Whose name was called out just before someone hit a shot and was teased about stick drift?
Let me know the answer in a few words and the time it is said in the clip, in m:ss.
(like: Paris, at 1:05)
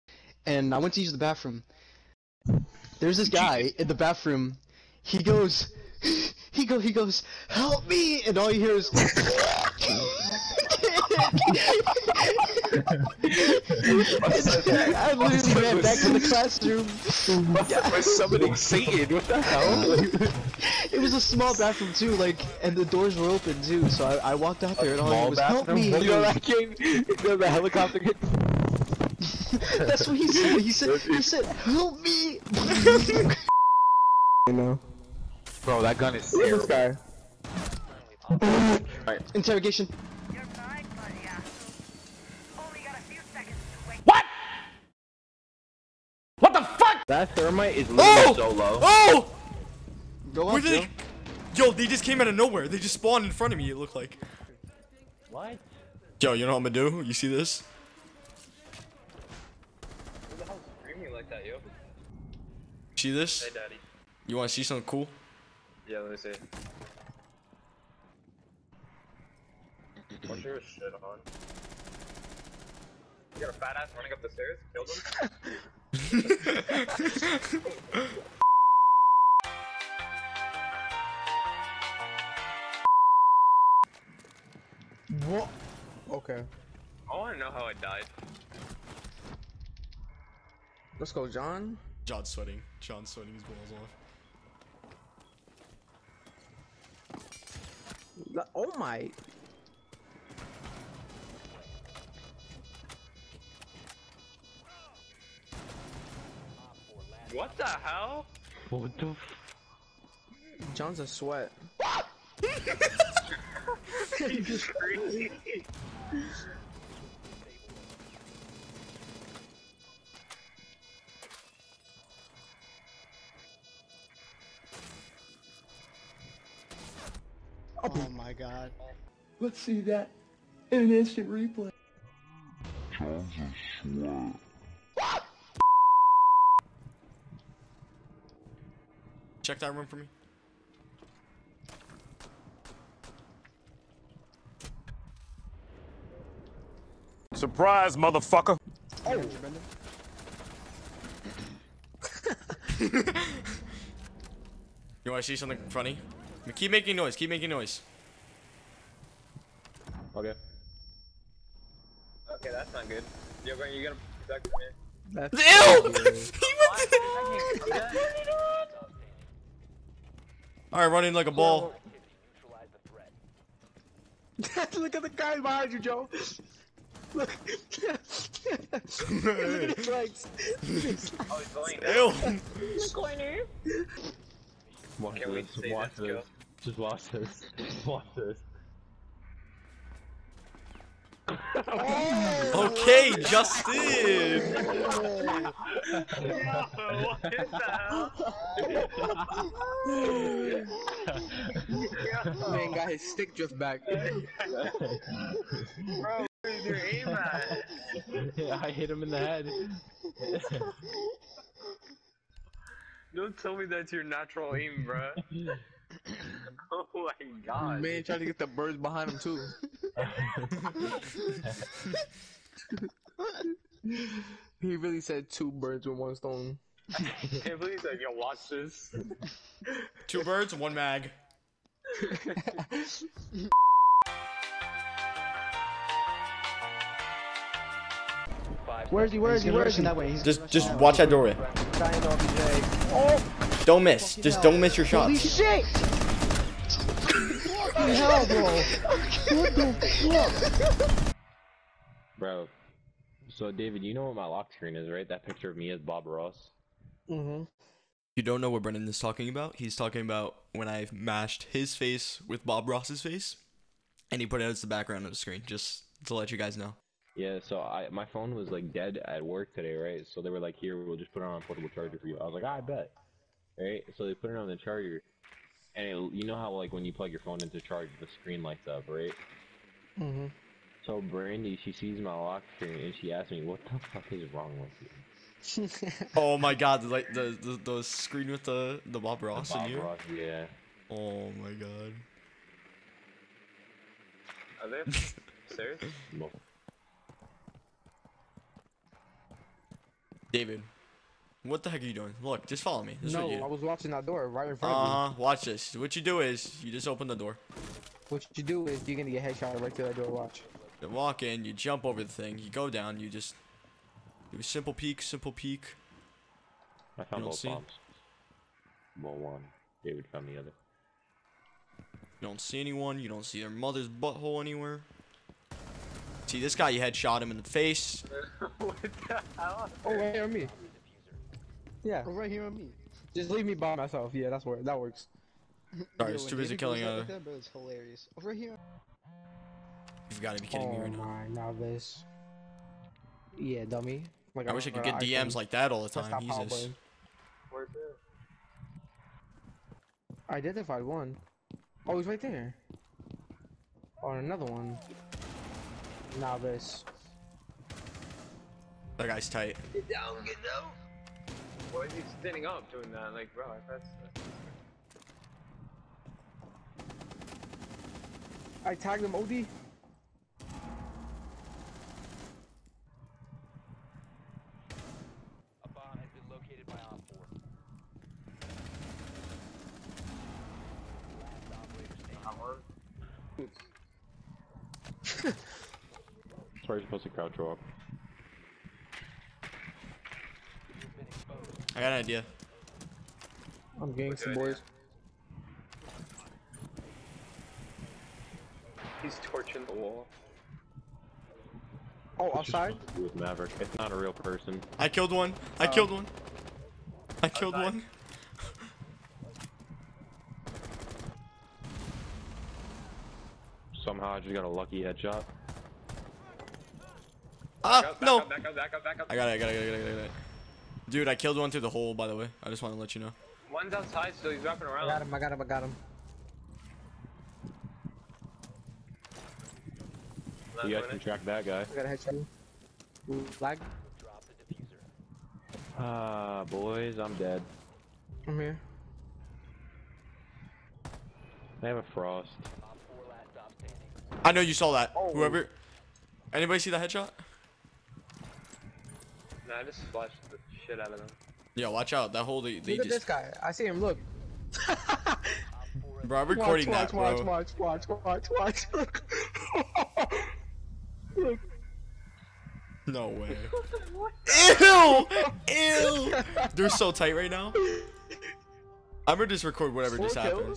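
Justin, at 3:13.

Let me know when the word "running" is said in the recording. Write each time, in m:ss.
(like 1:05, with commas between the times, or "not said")
1:13, 2:50.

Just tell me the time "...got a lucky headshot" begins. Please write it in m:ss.
6:54.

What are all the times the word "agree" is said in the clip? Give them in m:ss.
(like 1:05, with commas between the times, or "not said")
not said.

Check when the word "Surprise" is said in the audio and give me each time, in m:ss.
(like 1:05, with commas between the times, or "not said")
2:27.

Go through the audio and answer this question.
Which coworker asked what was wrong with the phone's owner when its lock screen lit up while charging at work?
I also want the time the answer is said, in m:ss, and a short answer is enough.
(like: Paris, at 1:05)
Brandy, at 4:41.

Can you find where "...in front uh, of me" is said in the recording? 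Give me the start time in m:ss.
5:04.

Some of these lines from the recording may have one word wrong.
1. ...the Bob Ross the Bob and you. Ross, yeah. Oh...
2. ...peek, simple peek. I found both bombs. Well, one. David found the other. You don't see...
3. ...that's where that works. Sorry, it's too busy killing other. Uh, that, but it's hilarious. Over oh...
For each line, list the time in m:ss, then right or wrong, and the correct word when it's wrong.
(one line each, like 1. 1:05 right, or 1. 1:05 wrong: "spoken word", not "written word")
1. 4:48 right
2. 5:14 right
3. 5:34 right.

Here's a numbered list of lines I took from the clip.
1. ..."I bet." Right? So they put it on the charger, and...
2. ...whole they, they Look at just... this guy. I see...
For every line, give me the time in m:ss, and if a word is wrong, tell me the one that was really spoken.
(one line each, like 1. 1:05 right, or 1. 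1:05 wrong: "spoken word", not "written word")
1. 4:32 right
2. 7:32 right.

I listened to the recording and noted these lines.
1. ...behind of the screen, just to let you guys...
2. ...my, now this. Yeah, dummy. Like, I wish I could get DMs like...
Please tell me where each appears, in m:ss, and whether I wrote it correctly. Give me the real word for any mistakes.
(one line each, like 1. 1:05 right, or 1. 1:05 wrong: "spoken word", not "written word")
1. 4:24 wrong: "background", not "behind"
2. 5:41 right.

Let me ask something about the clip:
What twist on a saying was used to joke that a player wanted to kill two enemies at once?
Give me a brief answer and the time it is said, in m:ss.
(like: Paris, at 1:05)
Two birds, one mag, at 3:50.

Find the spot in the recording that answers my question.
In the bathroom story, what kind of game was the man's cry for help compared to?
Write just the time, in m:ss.
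0:27.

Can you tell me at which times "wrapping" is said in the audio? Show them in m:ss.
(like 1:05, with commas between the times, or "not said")
7:04.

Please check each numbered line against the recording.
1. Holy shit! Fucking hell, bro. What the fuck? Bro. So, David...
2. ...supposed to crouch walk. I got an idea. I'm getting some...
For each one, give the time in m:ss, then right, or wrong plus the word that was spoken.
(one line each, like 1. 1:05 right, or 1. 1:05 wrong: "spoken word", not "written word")
1. 4:05 right
2. 6:26 right.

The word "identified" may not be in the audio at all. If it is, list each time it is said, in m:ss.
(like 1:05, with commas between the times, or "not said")
5:50.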